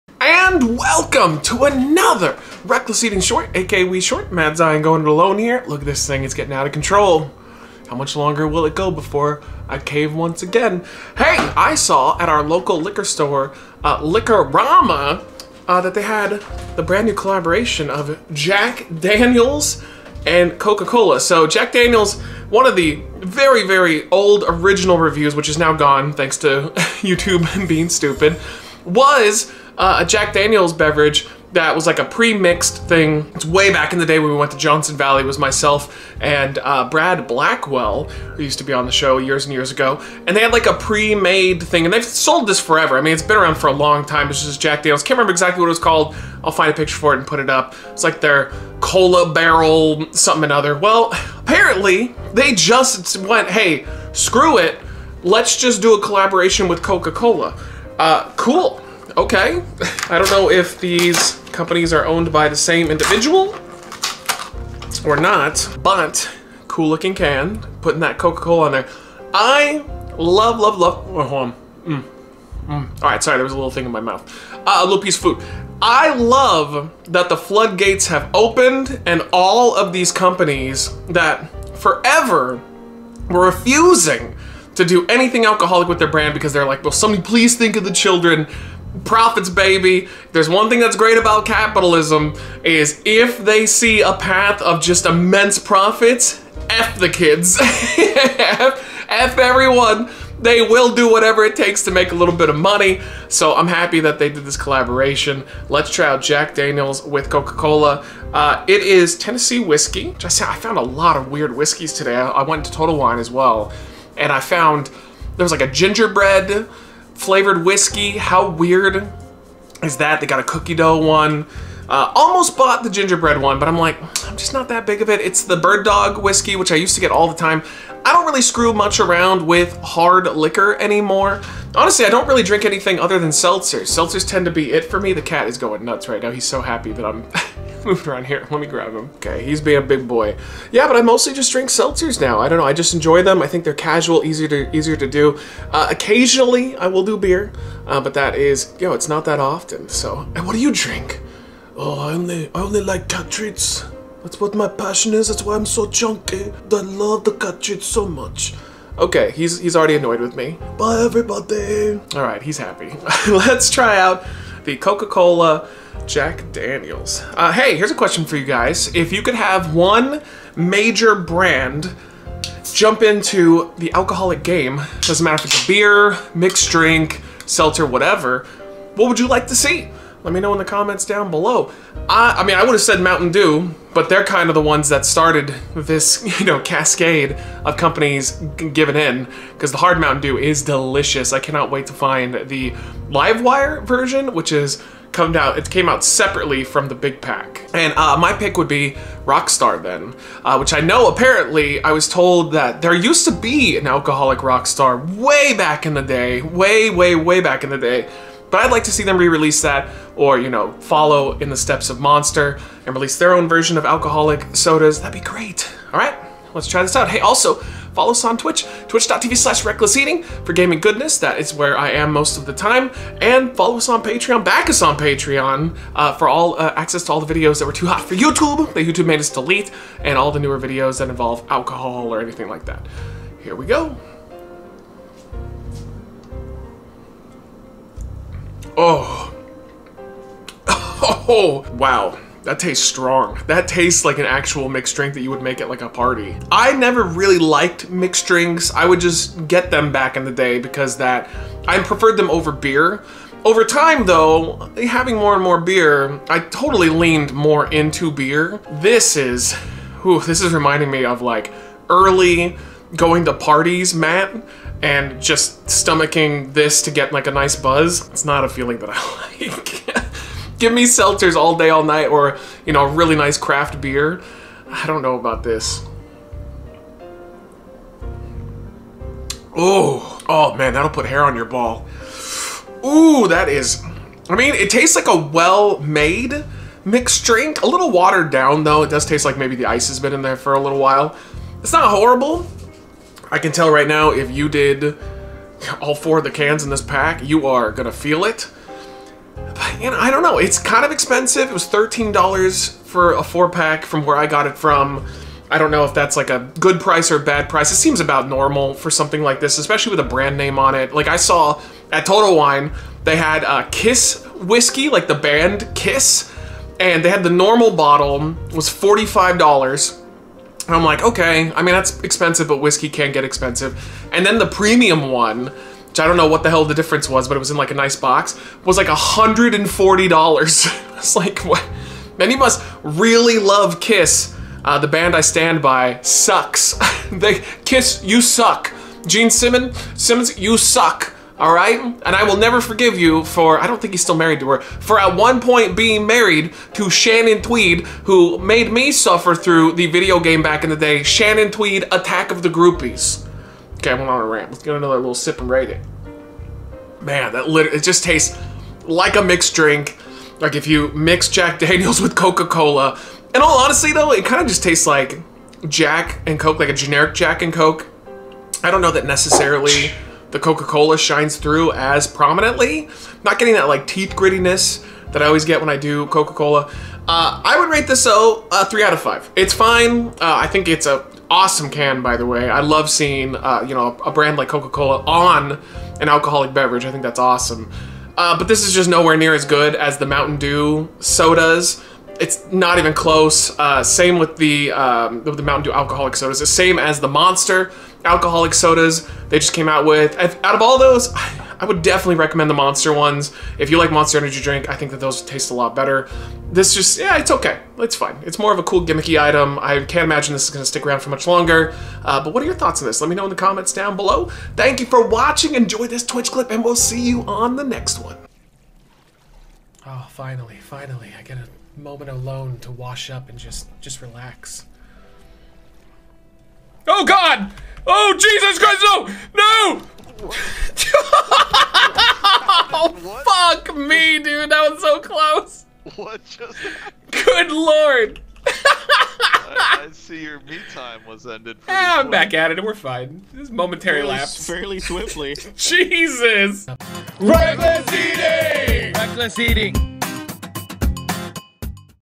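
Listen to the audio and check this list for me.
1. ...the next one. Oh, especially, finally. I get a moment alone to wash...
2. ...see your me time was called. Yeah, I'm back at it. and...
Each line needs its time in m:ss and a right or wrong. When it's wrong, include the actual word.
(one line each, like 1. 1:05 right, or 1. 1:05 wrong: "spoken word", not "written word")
1. 6:57 wrong: "finally", not "especially"
2. 7:19 wrong: "ended", not "called".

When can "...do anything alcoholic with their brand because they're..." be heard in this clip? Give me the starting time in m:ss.
1:24.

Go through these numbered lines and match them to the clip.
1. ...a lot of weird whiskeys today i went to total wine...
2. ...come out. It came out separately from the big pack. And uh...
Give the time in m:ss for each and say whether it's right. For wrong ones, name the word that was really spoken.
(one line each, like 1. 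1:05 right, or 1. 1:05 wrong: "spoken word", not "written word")
1. 1:50 right
2. 3:15 right.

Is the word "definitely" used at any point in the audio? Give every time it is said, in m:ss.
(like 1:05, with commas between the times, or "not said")
6:41.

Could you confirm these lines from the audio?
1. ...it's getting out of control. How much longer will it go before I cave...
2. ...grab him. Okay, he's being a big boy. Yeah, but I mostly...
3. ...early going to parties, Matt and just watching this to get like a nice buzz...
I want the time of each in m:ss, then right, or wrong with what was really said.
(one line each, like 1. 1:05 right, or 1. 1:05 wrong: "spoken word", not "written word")
1. 0:06 right
2. 2:18 right
3. 4:21 wrong: "stomaching", not "watching".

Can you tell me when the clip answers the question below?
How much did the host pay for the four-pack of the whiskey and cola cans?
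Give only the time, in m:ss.
5:01.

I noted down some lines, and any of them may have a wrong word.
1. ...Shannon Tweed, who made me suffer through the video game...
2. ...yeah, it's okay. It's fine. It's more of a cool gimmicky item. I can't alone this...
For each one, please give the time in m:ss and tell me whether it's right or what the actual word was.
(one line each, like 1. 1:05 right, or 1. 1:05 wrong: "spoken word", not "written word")
1. 5:46 right
2. 6:46 wrong: "imagine", not "alone".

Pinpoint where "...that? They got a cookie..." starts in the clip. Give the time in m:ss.
1:59.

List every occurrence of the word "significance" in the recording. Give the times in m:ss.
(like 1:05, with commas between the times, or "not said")
not said.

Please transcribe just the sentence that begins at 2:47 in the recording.
Uh, hey, here's a question for you guys.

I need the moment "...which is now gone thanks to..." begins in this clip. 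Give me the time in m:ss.
0:25.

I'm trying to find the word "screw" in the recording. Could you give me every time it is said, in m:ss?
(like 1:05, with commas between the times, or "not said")
0:54, 2:08.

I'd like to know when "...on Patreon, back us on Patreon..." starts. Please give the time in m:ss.
3:43.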